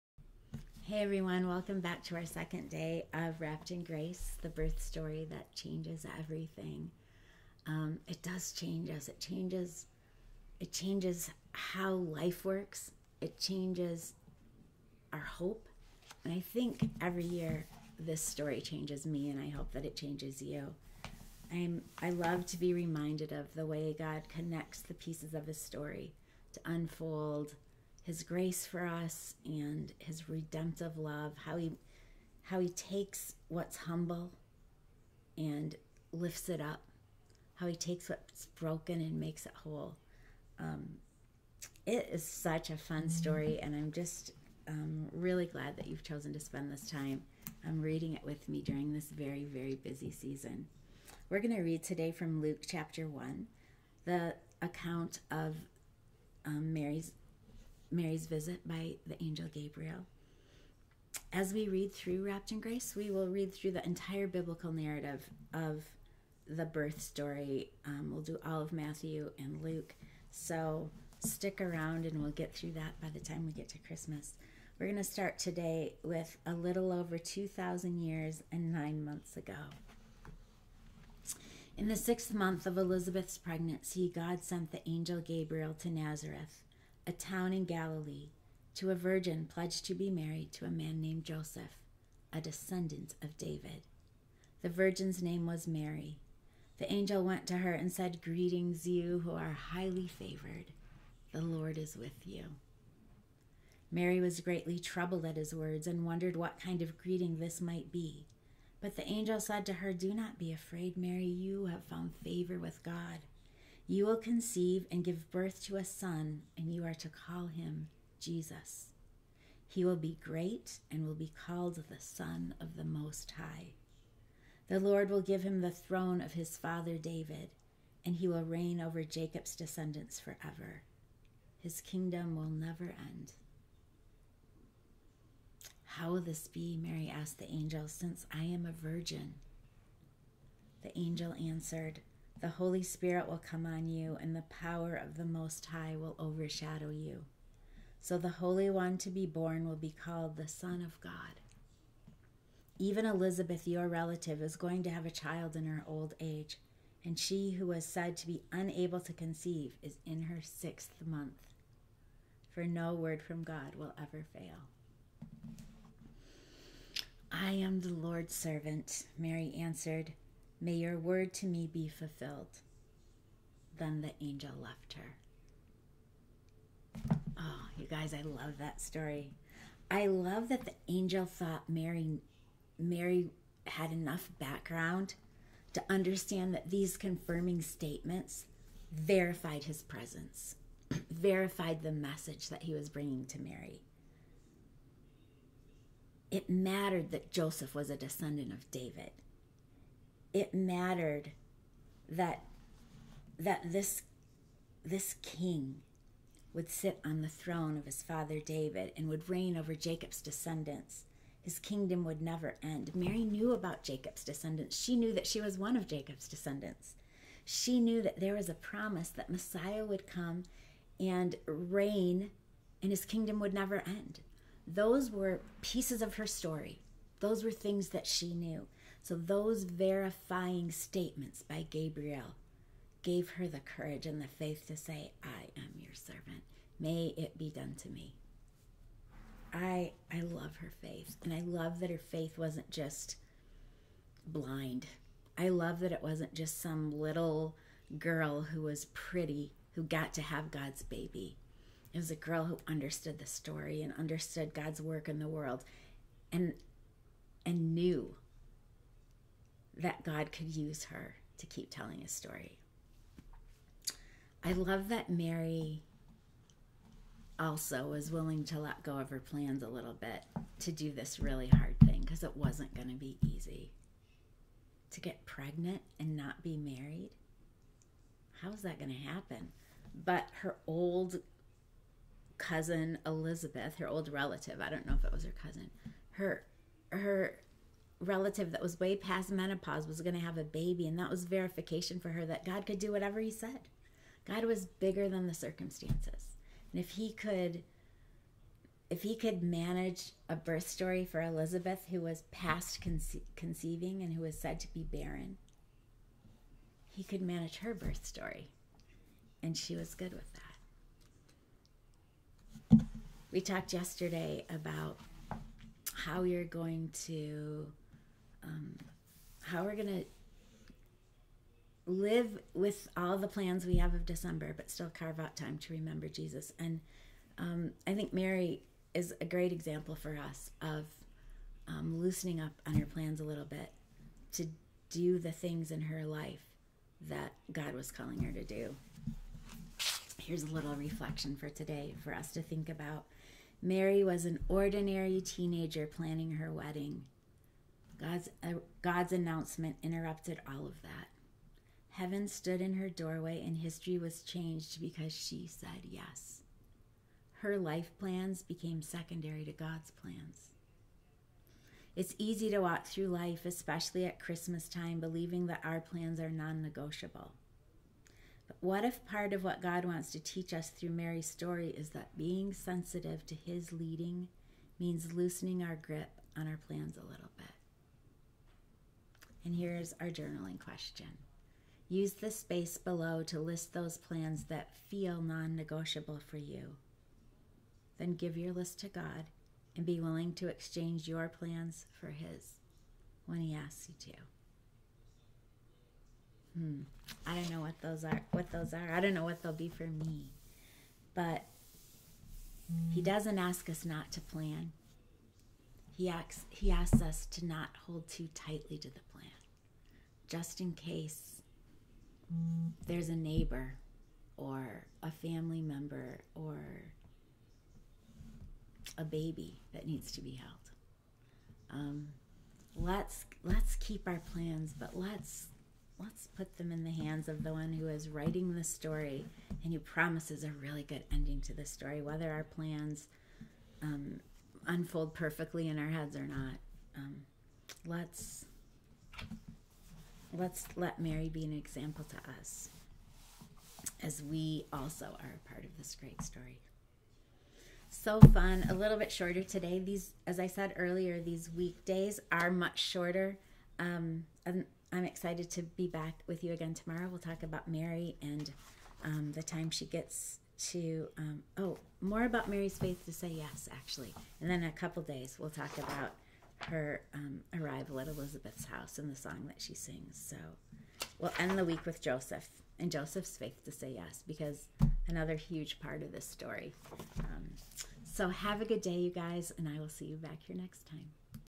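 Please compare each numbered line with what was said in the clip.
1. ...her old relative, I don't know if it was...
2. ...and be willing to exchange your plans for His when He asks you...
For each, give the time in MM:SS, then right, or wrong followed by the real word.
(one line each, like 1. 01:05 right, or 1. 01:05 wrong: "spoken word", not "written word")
1. 04:43 right
2. 06:29 right.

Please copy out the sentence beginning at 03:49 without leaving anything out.
So those verifying statements by Gabriel gave her the courage and the faith to say, I am your servant.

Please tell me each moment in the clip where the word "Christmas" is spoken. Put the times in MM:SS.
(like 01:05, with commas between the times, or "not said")
01:13, 06:04.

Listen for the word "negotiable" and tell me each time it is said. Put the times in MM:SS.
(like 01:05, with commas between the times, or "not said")
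06:06, 06:25.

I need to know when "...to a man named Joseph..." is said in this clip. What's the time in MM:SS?
01:30.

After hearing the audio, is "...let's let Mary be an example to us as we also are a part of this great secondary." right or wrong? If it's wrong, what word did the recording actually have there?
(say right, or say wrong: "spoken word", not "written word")
wrong: "story", not "secondary".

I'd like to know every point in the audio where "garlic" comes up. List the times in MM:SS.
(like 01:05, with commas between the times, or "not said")
not said.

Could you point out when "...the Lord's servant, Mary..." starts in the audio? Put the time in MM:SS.
02:47.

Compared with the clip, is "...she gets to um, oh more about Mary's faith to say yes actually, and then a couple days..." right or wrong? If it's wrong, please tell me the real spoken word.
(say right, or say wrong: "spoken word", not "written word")
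right.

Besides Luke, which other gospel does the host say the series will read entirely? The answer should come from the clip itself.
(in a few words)
Matthew.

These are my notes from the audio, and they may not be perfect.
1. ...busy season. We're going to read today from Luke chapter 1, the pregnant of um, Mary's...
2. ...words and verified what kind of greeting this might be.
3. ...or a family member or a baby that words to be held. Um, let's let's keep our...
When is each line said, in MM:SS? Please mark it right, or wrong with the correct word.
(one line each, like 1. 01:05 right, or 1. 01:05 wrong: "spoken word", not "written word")
1. 00:49 wrong: "account", not "pregnant"
2. 01:45 wrong: "wondered", not "verified"
3. 06:54 wrong: "needs", not "words".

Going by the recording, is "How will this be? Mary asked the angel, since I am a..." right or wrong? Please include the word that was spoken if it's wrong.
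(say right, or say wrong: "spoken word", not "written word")
right.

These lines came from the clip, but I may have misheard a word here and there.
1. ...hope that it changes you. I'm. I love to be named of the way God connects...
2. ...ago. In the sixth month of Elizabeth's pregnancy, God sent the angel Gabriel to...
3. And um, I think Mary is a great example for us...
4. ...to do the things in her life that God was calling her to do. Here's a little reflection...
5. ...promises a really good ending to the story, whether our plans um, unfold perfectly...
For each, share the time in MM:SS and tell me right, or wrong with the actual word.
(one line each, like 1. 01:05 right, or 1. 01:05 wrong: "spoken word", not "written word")
1. 00:19 wrong: "reminded", not "named"
2. 01:19 right
3. 05:26 right
4. 05:34 right
5. 07:09 right.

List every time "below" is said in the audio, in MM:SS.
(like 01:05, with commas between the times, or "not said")
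06:22.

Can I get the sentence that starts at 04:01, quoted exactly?
And I love that her faith wasn't just blind.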